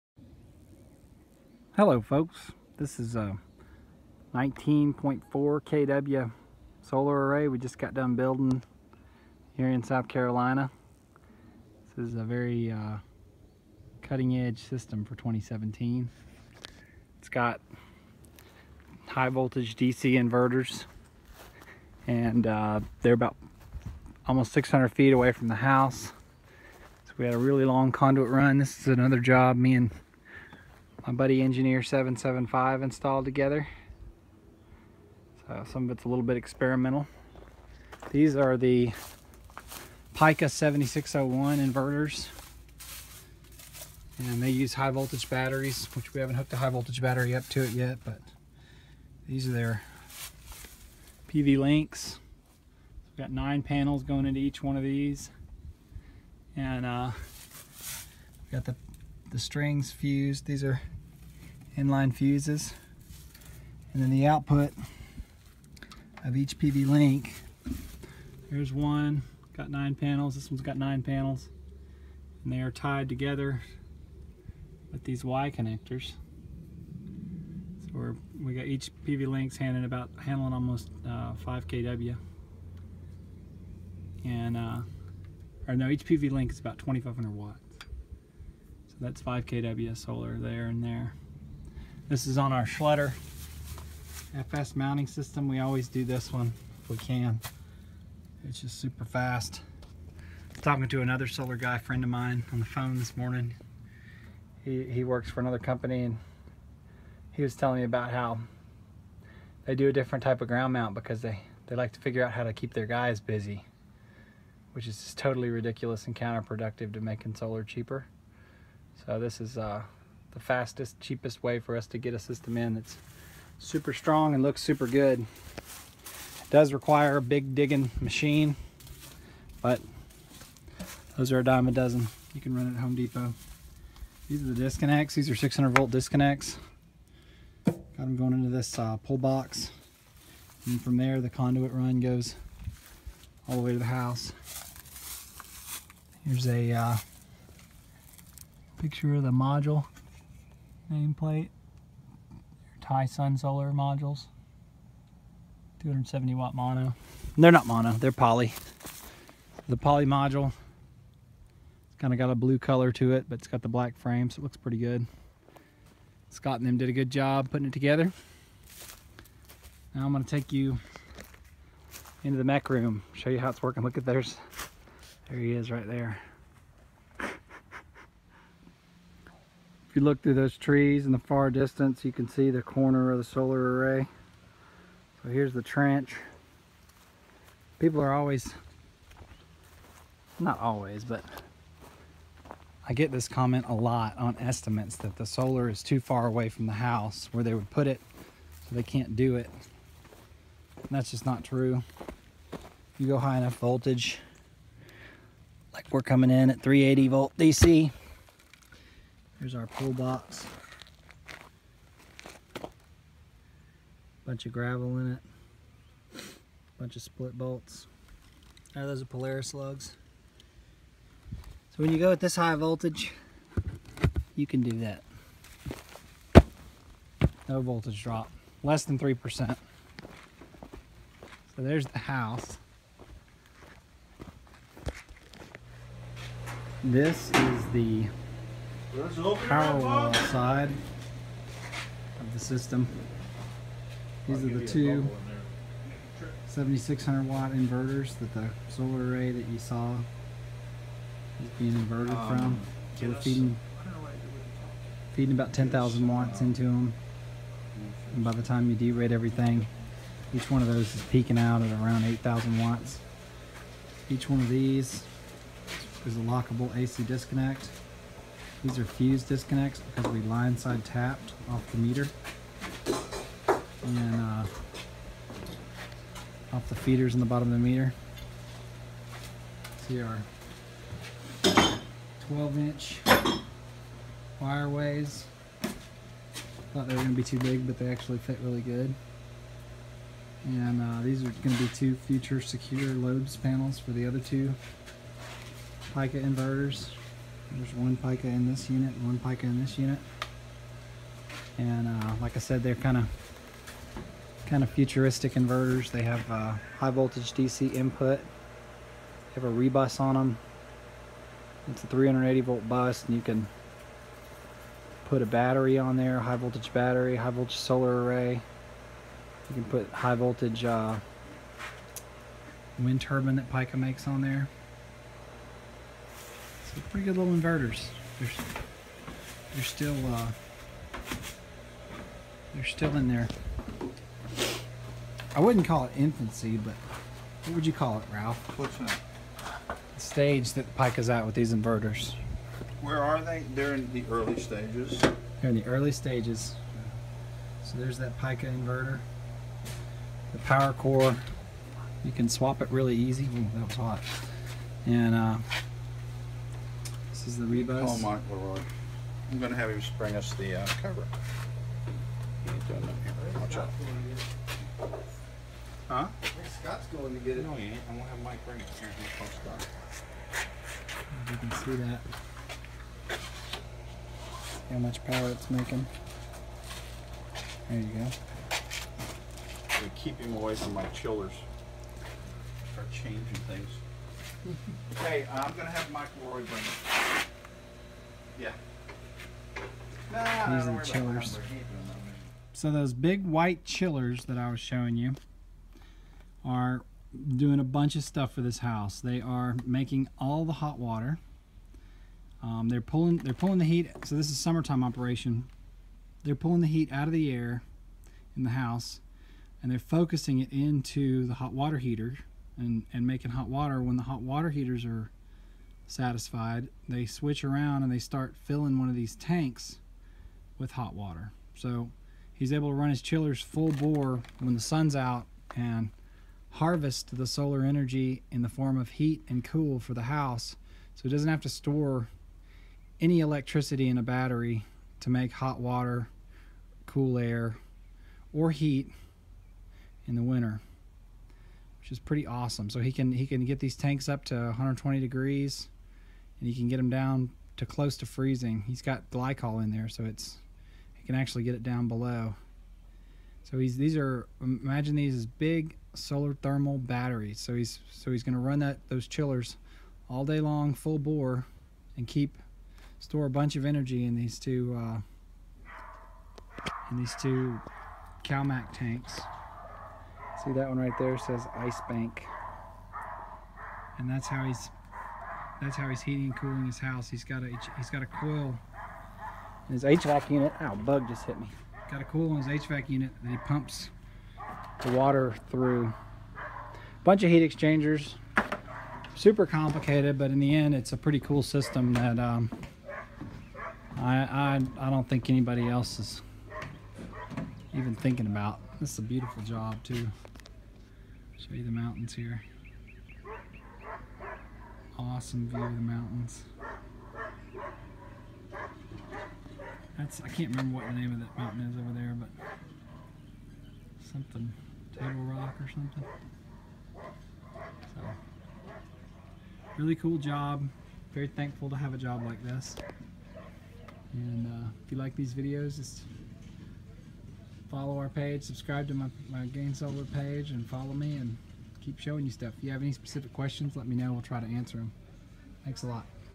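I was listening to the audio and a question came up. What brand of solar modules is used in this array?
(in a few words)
Talesun.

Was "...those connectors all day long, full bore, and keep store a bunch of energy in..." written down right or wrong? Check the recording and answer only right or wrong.
wrong.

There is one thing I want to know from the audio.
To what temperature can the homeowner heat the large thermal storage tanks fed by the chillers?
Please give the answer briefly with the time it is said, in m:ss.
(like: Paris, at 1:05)
120 degrees, at 7:24.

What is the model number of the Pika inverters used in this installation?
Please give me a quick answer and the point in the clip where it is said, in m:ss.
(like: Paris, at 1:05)
7601, at 0:40.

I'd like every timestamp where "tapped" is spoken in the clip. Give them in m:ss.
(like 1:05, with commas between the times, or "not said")
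4:30.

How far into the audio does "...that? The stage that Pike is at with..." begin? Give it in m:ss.
5:38.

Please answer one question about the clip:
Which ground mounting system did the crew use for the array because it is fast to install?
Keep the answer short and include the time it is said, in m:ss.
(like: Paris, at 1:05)
Schletter FS, at 1:32.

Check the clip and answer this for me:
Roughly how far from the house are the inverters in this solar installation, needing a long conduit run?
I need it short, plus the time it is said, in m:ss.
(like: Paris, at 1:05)
600 feet, at 0:24.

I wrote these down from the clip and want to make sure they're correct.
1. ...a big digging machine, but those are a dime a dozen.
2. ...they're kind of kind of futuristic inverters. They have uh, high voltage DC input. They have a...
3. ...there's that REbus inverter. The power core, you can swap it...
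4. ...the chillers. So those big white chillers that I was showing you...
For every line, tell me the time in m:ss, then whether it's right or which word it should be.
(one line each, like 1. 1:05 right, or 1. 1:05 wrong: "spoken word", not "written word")
1. 2:07 right
2. 5:02 right
3. 5:47 wrong: "Pika", not "REbus"
4. 6:30 right.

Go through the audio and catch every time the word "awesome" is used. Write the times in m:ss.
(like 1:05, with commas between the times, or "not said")
7:22, 8:24.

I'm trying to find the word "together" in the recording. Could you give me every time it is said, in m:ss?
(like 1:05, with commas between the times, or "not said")
0:33, 1:13, 2:47.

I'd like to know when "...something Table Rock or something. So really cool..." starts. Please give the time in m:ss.
8:34.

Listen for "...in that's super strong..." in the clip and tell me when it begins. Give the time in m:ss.
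2:02.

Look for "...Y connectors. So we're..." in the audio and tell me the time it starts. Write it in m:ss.
1:15.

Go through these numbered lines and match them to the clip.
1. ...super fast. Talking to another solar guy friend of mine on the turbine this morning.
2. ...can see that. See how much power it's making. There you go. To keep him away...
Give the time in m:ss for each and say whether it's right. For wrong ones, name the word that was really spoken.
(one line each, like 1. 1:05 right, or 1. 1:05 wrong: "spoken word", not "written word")
1. 1:38 wrong: "phone", not "turbine"
2. 6:11 right.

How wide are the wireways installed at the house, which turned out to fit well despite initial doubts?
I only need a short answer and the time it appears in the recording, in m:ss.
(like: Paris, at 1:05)
12 inch, at 4:42.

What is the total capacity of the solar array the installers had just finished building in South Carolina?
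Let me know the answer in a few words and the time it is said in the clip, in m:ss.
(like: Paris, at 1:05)
19.4 kW, at 0:04.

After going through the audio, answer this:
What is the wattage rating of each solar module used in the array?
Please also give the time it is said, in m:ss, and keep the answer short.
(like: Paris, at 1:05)
270 watt, at 2:35.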